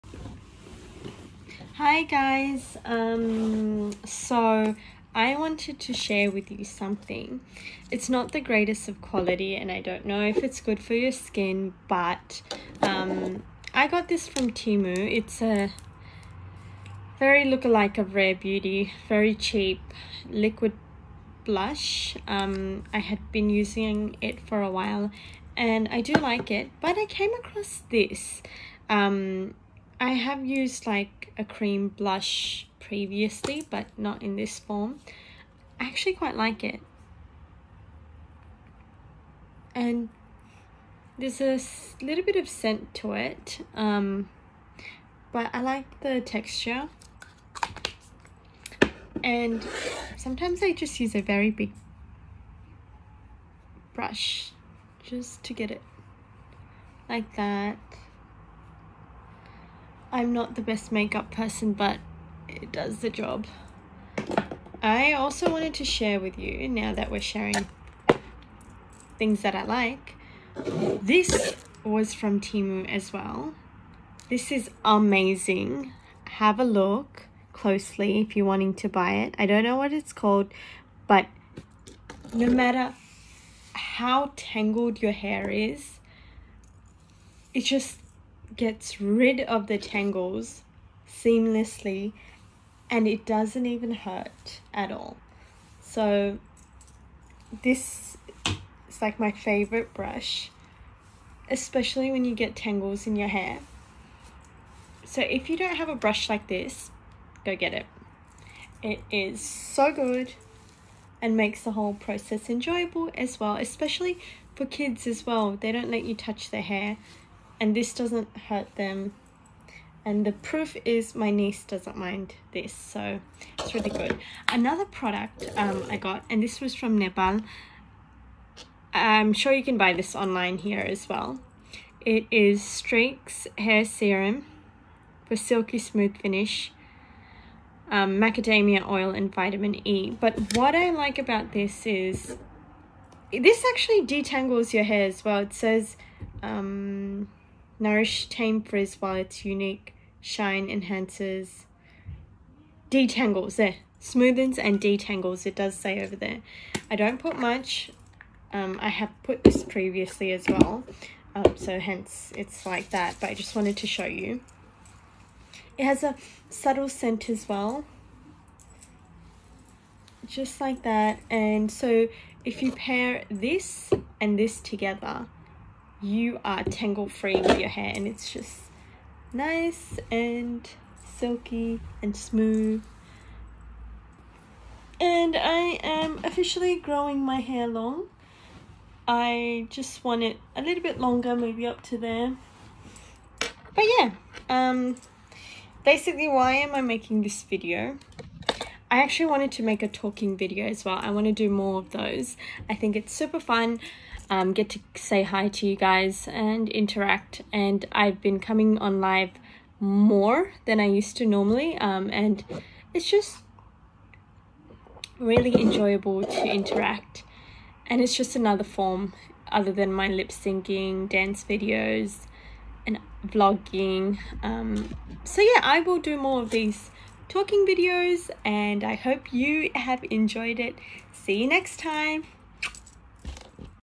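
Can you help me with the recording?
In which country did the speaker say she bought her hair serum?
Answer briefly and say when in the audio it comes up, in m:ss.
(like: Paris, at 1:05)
Nepal, at 2:06.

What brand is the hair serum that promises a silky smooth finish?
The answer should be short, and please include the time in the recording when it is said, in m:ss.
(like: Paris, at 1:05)
Streax, at 2:12.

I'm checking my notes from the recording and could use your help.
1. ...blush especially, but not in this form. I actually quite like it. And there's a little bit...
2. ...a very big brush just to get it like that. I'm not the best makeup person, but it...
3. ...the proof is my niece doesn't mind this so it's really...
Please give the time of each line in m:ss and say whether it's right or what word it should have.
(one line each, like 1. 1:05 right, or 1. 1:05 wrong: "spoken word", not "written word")
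1. 0:31 wrong: "previously", not "especially"
2. 0:51 right
3. 2:00 right.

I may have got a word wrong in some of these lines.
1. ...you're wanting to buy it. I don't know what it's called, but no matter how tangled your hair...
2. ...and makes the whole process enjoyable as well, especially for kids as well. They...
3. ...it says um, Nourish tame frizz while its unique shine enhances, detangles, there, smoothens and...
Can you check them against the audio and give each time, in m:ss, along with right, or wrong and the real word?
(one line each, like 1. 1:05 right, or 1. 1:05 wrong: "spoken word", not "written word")
1. 1:18 right
2. 1:51 right
3. 2:25 right.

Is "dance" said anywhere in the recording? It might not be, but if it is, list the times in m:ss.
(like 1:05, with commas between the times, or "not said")
3:41.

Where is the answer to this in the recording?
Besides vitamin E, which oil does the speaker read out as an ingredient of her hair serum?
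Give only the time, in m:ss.
2:18.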